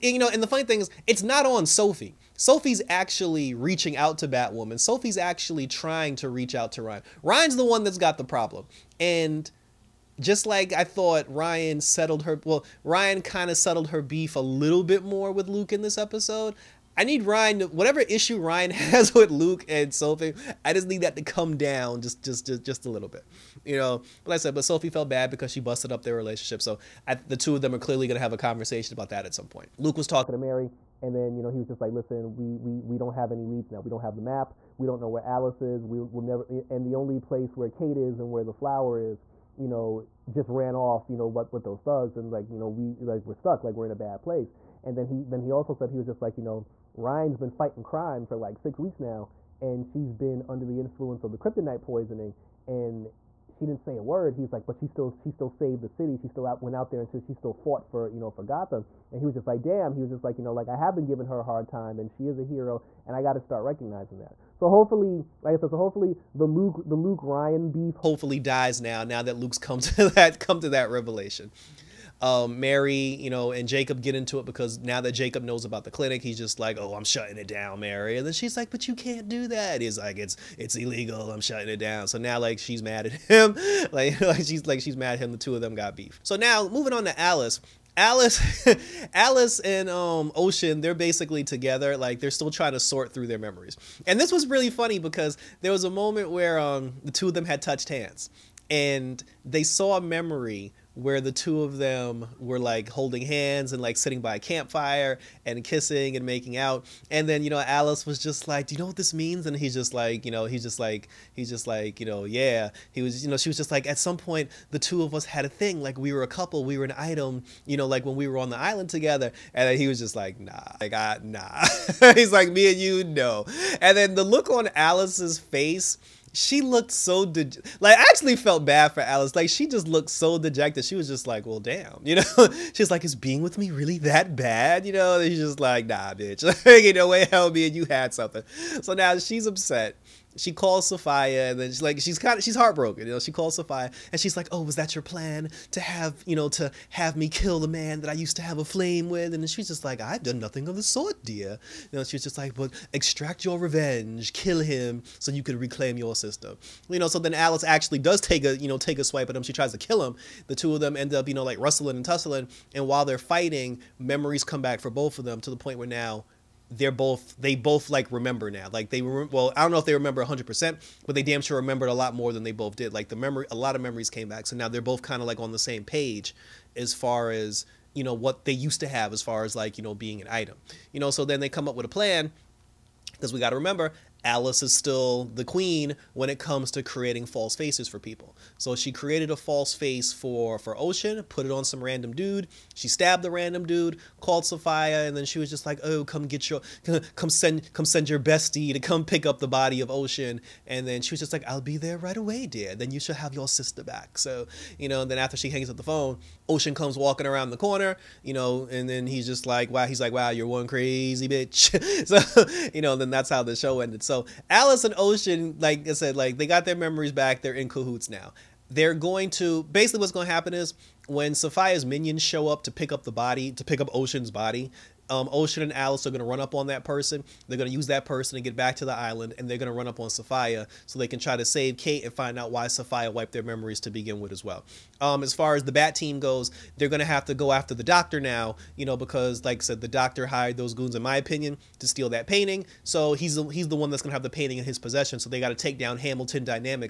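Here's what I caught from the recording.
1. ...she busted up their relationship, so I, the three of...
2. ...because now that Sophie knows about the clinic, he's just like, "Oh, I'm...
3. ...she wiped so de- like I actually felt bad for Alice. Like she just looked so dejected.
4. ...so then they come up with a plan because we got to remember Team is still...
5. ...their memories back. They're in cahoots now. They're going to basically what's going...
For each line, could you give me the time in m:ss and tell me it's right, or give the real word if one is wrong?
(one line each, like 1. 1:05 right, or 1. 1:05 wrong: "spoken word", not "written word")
1. 0:25 wrong: "two", not "three"
2. 1:14 wrong: "Jacob", not "Sophie"
3. 2:06 wrong: "looked", not "wiped"
4. 3:01 wrong: "Alice", not "Team"
5. 3:36 right.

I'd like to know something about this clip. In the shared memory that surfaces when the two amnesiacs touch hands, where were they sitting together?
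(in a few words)
By a campfire.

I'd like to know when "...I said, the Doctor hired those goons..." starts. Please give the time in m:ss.
3:59.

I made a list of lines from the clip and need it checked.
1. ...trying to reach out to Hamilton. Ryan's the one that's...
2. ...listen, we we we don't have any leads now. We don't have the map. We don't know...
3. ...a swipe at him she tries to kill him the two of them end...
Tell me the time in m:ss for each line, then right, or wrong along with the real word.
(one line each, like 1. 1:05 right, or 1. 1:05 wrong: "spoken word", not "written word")
1. 0:05 wrong: "Ryan", not "Hamilton"
2. 0:31 right
3. 2:38 right.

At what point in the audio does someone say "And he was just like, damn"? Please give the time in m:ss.
0:59.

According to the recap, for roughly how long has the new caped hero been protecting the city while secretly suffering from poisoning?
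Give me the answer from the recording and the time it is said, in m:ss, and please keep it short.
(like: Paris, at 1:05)
6 weeks, at 0:48.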